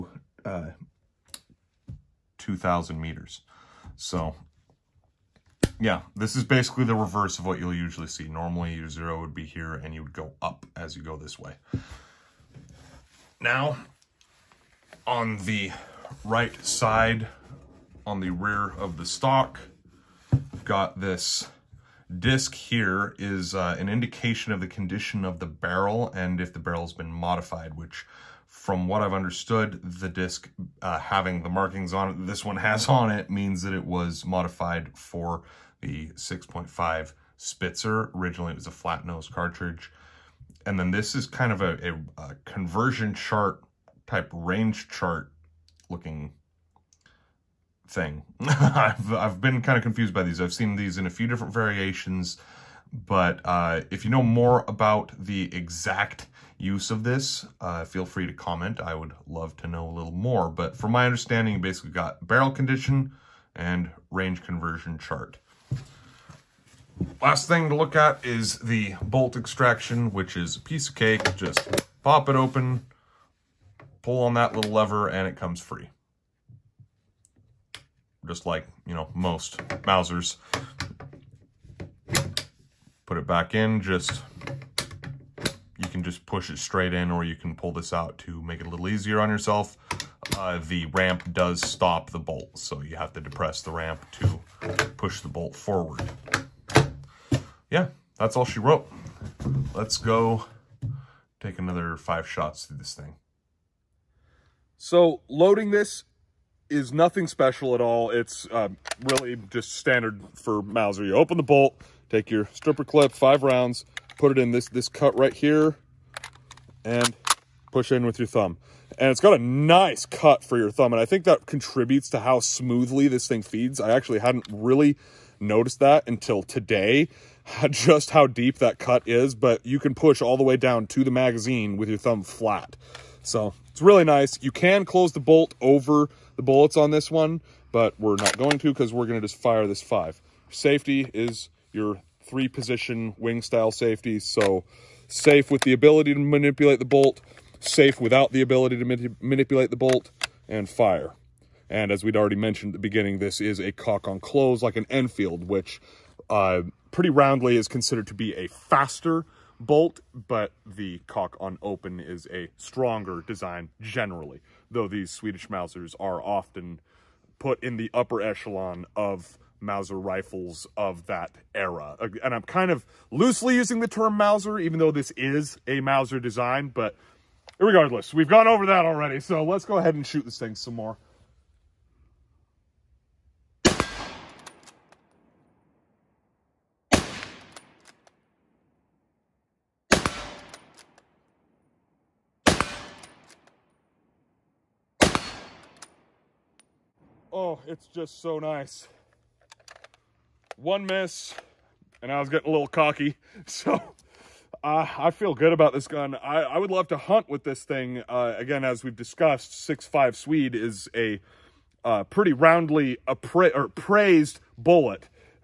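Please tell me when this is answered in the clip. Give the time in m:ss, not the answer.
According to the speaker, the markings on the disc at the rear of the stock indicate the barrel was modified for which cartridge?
0:36.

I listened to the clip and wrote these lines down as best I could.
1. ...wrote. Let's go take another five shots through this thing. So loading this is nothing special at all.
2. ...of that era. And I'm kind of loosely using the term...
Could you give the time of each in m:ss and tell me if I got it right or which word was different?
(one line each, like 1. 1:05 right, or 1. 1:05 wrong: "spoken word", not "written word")
1. 1:38 right
2. 2:50 right.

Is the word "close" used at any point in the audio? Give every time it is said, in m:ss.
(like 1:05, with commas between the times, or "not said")
2:14, 2:34.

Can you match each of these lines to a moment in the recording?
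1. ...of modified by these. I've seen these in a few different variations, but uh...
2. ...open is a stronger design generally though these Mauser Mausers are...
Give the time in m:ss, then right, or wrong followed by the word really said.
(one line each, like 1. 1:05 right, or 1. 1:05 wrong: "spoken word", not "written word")
1. 0:49 wrong: "confused", not "modified"
2. 2:41 wrong: "Swedish", not "Mauser".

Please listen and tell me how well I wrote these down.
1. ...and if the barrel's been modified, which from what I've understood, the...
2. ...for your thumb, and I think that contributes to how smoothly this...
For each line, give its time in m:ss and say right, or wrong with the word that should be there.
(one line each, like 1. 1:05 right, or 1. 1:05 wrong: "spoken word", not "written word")
1. 0:26 right
2. 2:00 right.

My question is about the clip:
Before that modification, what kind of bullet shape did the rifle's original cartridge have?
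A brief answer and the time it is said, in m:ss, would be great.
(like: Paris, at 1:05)
Flat nose, at 0:38.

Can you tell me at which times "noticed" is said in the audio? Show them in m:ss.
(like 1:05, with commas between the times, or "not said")
2:05.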